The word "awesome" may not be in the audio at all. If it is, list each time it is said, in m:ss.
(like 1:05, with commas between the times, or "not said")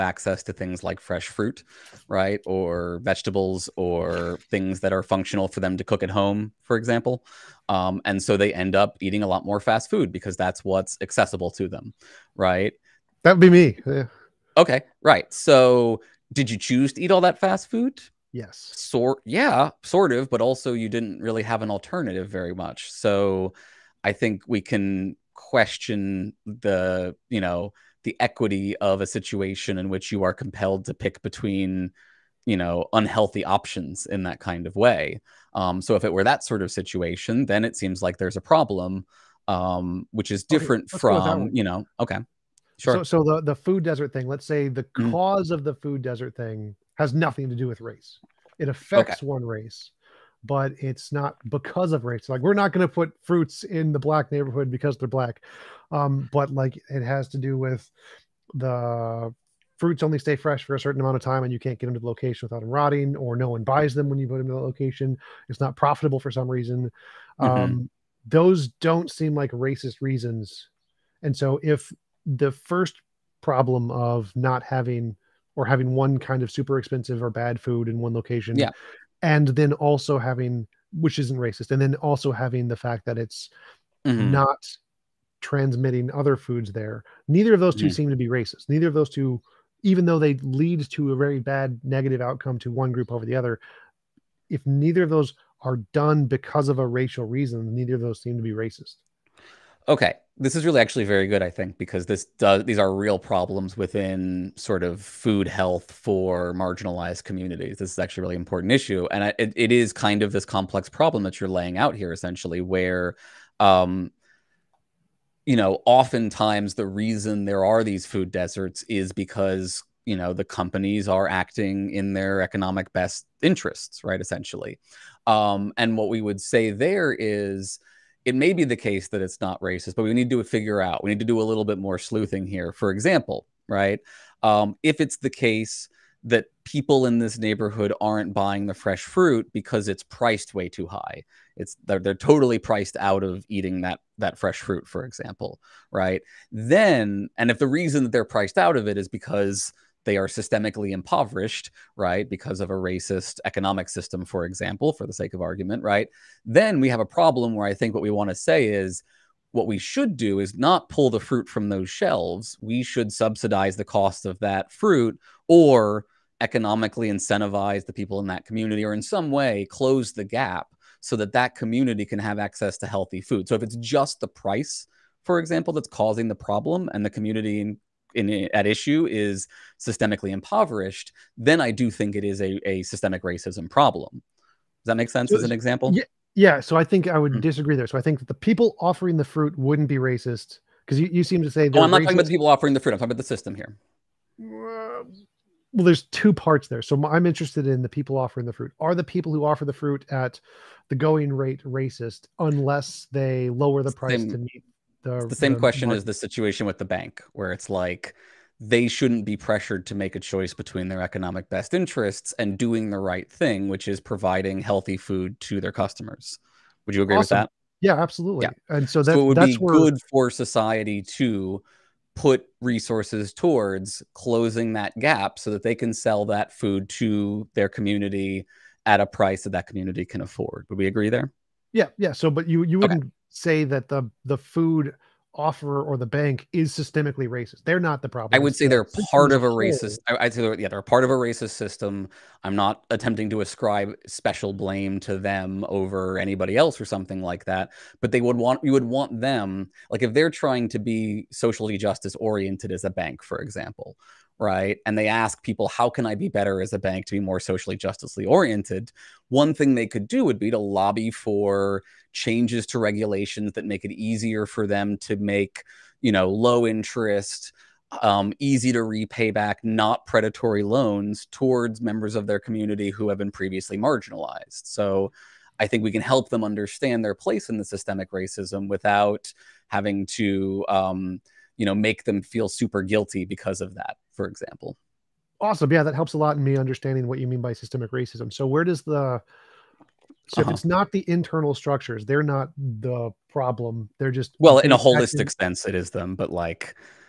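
3:37, 4:45.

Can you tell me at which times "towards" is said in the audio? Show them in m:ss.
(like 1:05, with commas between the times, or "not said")
3:43, 4:31.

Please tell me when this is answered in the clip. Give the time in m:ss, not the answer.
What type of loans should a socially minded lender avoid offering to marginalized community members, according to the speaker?
4:30.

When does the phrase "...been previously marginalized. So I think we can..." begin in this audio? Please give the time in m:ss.
4:33.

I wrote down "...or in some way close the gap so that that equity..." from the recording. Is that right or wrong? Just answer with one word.
wrong.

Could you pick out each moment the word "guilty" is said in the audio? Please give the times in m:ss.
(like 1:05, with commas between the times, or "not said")
4:42.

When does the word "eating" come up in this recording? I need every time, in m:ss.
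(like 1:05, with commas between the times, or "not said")
0:08, 2:23.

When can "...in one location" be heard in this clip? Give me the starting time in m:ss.
1:17.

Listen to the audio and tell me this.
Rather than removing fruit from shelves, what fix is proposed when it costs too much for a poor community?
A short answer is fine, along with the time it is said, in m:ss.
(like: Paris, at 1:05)
subsidize the cost, at 2:43.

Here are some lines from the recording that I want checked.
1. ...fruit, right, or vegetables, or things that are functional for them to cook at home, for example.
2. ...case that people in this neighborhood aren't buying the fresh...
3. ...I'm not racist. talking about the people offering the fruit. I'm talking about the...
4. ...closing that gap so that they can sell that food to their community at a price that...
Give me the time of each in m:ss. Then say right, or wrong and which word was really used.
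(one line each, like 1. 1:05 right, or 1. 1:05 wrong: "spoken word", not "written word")
1. 0:01 right
2. 2:15 right
3. 3:11 right
4. 3:44 right.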